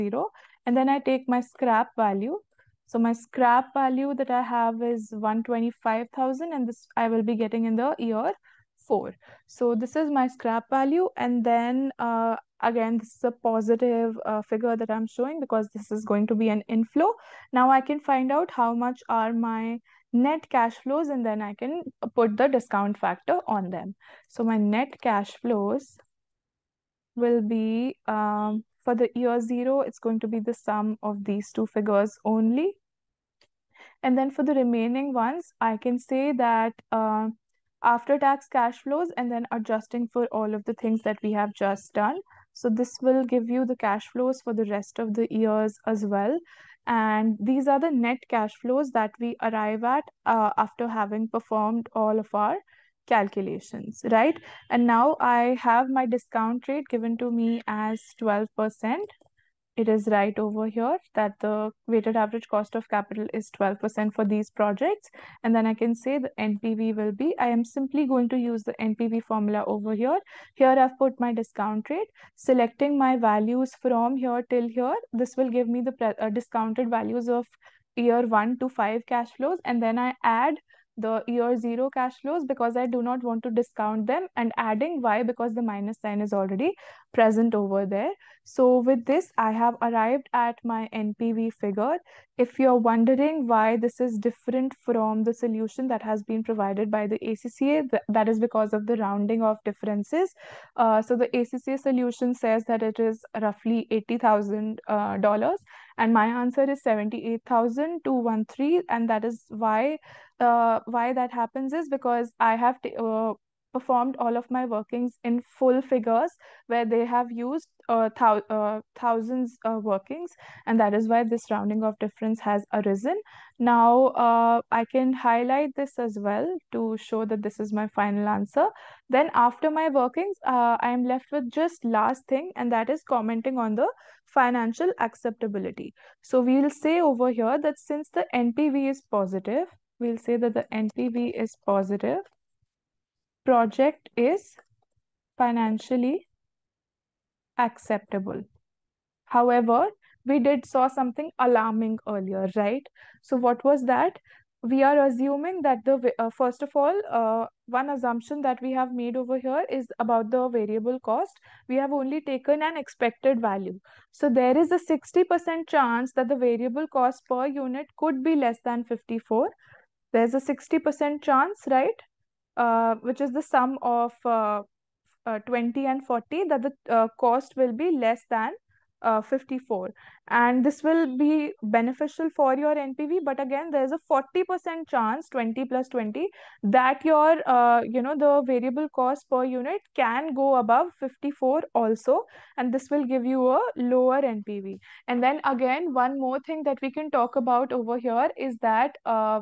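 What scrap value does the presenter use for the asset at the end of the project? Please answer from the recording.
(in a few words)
125,000.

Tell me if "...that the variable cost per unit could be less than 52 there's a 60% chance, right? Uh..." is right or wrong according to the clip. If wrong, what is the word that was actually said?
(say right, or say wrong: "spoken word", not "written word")
wrong: "54", not "52".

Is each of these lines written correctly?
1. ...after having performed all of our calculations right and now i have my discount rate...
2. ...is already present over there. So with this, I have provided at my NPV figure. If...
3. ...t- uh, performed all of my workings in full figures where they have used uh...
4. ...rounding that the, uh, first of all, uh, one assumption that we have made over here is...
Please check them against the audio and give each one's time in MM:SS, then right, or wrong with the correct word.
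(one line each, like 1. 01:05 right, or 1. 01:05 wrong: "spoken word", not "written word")
1. 00:50 right
2. 01:26 wrong: "arrived", not "provided"
3. 01:52 right
4. 02:35 wrong: "assuming", not "rounding".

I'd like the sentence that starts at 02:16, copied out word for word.
So we will say over here that since the NPV is positive, we'll say that the NPV is positive.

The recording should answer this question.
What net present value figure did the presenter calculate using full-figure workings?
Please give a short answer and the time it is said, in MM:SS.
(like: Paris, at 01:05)
78,213, at 01:46.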